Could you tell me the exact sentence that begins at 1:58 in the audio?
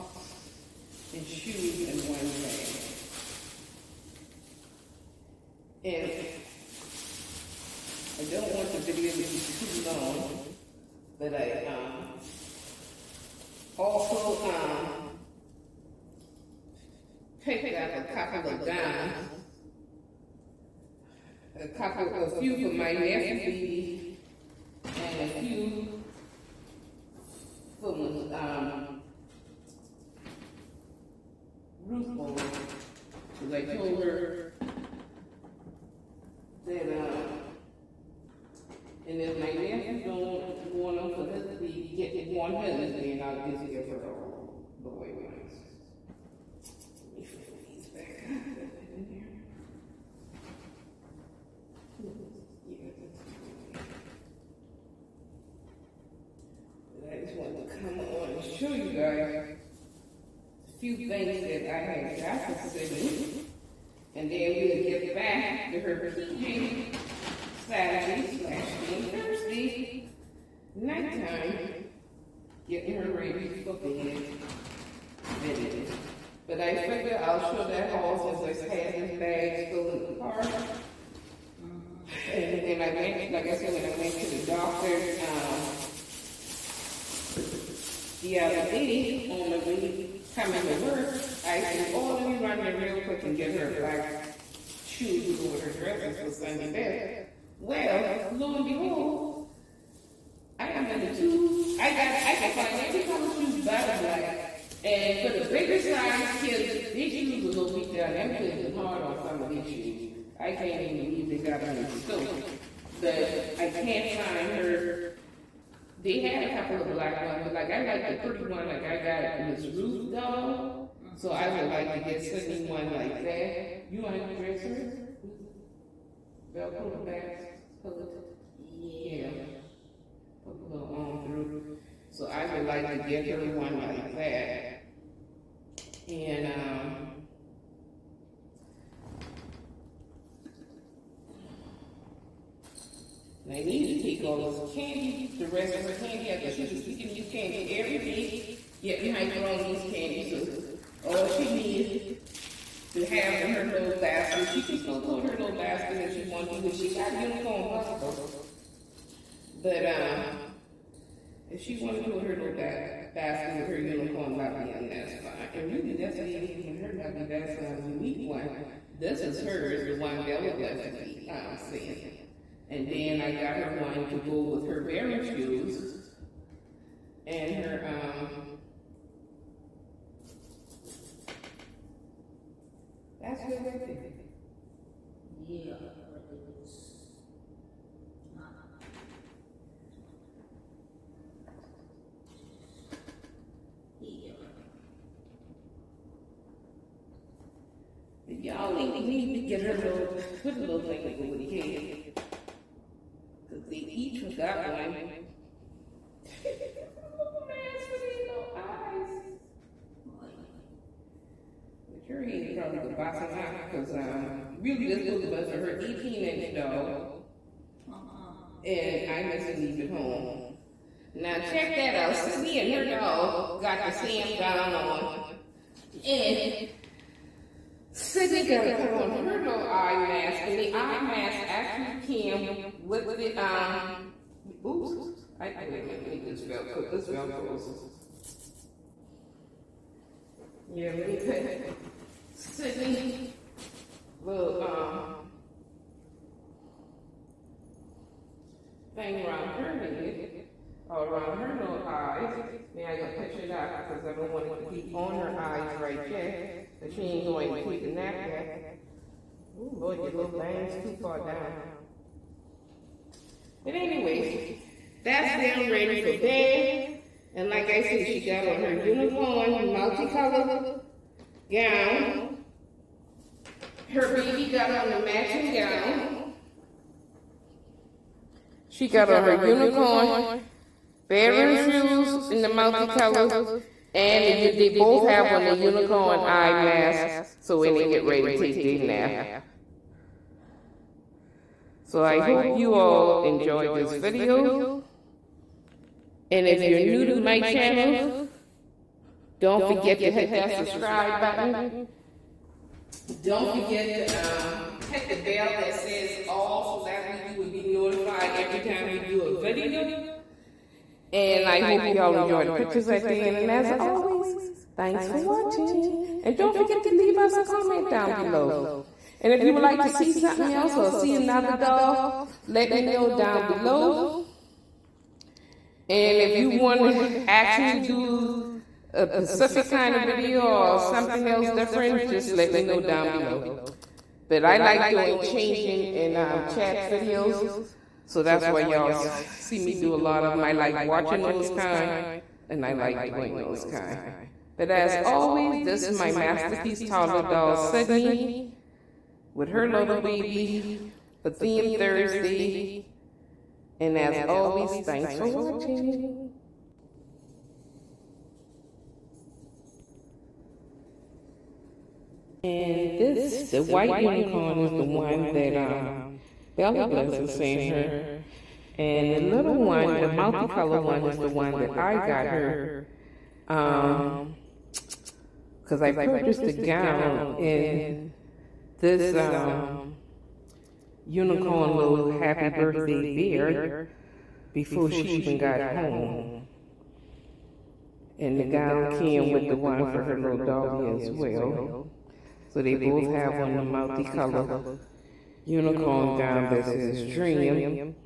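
Like I got Miss Ruth doll, so I would like to get Sydney one like that.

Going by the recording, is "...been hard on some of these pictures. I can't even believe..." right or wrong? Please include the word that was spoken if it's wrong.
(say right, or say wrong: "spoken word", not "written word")
wrong: "shoes", not "pictures".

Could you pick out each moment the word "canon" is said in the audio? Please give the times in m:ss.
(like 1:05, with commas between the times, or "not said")
not said.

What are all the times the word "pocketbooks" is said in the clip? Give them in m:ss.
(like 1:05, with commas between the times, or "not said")
2:37.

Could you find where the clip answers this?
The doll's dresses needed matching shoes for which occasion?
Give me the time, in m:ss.
1:36.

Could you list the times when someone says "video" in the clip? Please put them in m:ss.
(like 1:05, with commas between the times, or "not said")
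0:08, 1:15, 4:53, 5:09, 5:30, 5:36.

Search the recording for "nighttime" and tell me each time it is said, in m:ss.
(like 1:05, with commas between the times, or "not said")
1:10.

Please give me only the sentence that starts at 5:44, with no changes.
But as always, this is my masterpiece toddler doll, Sydney, with her little baby for Theme Thursday.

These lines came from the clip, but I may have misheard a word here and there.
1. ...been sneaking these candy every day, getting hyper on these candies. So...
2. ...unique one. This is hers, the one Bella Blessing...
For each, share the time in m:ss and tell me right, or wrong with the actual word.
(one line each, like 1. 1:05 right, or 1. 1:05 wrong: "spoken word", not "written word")
1. 2:26 right
2. 2:47 right.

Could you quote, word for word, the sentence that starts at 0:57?
I just wanted to come on and show you guys a few things that I had got for Sydney.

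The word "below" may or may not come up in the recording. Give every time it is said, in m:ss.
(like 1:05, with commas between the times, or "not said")
5:18, 5:23, 5:33.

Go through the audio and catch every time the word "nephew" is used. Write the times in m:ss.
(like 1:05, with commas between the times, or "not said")
0:22, 0:39.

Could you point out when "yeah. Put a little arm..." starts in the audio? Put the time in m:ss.
2:08.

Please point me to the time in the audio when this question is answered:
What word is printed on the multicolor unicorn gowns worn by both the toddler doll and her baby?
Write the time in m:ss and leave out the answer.
6:37.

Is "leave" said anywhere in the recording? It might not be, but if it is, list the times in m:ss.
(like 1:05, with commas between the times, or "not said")
3:39, 5:16.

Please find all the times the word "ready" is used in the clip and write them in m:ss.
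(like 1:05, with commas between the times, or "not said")
1:13, 4:25, 4:48.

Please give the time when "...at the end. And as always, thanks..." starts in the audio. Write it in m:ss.
5:12.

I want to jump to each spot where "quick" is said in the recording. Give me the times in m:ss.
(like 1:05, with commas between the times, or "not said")
1:33.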